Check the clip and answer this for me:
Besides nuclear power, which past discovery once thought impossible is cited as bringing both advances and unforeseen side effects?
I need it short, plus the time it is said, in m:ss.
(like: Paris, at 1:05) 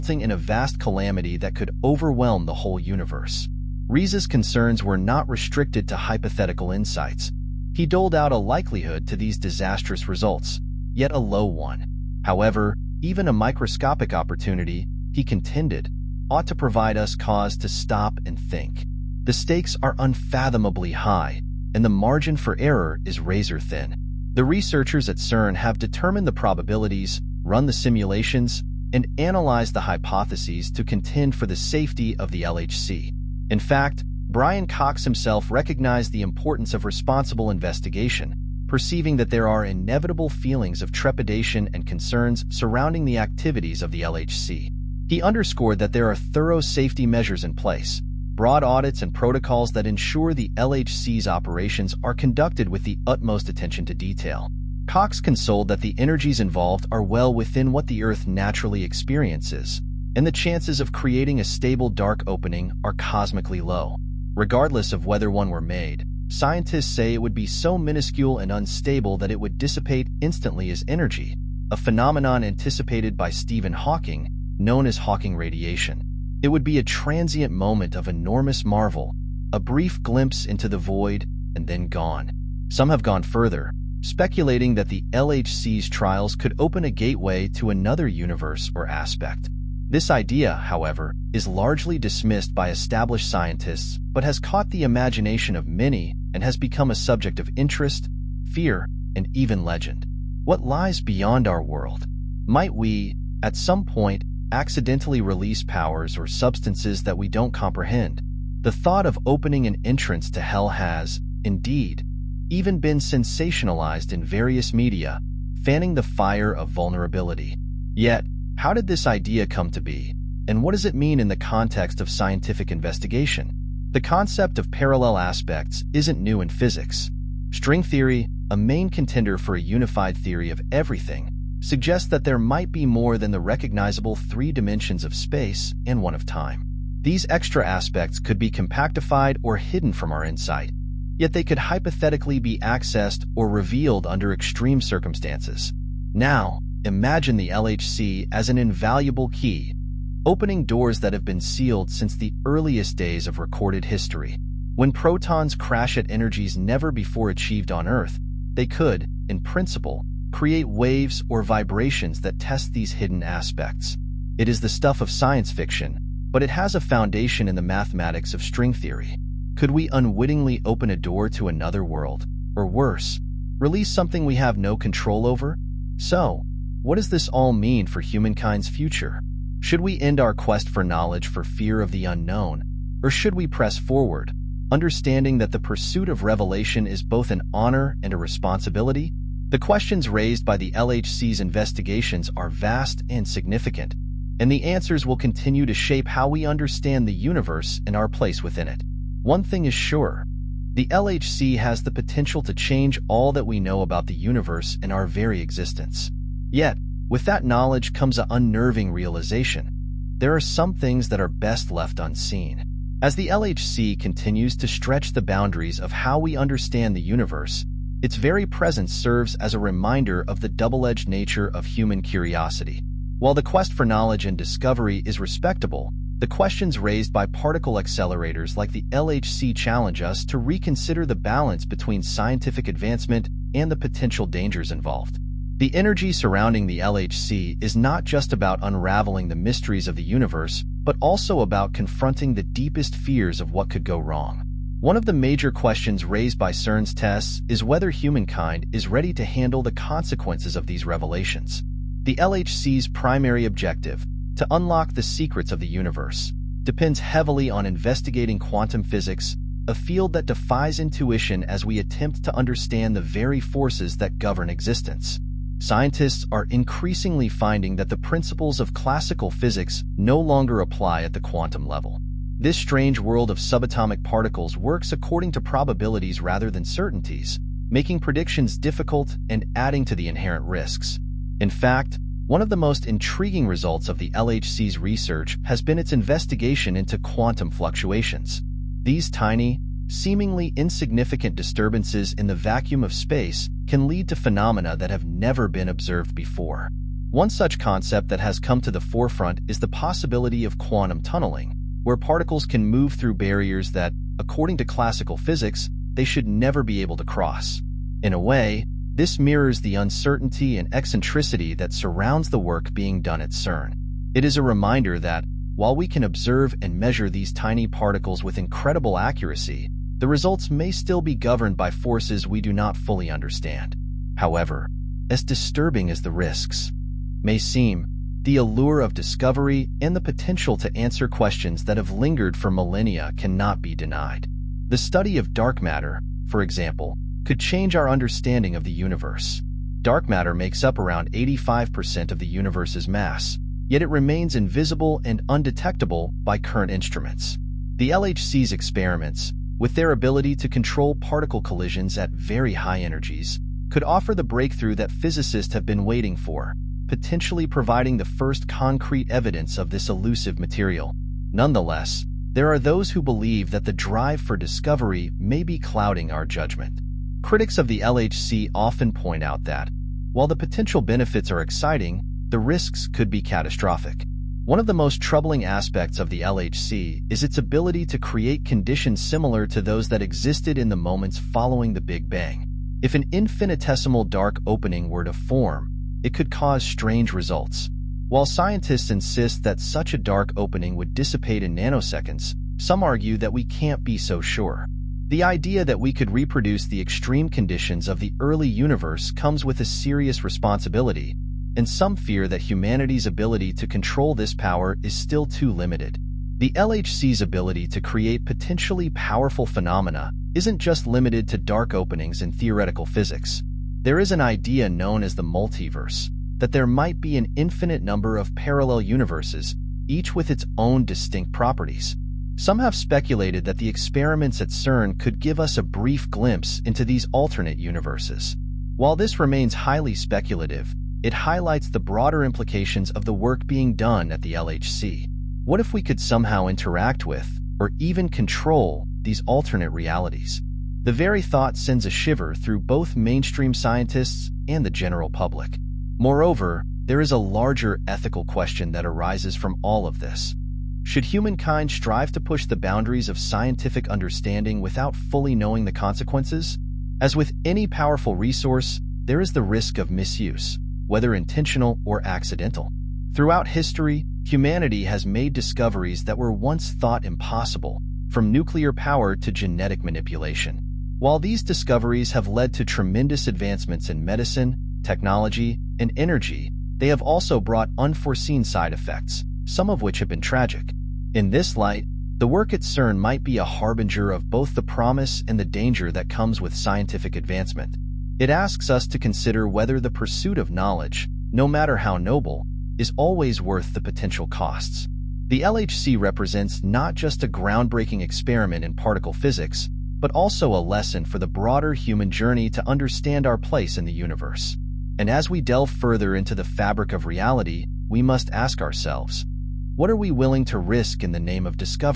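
Genetic manipulation, at 7:49.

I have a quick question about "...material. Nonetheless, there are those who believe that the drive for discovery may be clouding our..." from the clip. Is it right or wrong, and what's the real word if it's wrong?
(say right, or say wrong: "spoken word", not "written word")
right.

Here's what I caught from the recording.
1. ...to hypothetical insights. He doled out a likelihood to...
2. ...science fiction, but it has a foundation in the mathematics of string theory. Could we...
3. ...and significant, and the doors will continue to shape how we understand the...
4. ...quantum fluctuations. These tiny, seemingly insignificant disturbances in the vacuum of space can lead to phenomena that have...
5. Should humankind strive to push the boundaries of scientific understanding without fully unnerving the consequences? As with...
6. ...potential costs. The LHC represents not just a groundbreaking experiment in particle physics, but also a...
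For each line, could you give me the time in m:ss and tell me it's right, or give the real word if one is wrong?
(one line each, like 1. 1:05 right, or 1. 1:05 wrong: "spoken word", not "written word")
1. 0:05 right
2. 2:45 right
3. 3:13 wrong: "answers", not "doors"
4. 4:46 right
5. 7:30 wrong: "knowing", not "unnerving"
6. 8:13 right.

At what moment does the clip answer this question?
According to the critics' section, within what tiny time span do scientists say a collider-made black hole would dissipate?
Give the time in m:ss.
6:31.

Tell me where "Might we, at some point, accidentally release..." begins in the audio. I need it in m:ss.
1:42.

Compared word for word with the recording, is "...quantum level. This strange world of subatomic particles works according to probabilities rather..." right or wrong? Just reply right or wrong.
right.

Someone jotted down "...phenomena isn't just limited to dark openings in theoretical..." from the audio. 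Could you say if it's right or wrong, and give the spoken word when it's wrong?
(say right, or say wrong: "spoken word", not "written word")
right.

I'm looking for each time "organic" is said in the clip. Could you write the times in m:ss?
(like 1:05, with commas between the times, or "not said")
not said.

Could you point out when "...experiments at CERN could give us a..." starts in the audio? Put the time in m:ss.
7:03.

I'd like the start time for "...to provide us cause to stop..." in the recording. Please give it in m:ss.
0:16.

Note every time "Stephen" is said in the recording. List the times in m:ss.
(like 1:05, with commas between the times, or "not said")
1:13.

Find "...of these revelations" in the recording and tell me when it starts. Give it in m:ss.
4:10.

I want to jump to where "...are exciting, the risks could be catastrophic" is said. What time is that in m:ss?
6:11.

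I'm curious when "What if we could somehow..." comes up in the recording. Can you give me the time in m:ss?
7:15.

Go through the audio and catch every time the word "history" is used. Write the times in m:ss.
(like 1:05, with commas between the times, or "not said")
2:33, 7:43.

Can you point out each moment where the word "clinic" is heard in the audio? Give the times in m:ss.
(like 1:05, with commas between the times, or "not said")
not said.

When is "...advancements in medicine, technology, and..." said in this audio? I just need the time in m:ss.
7:53.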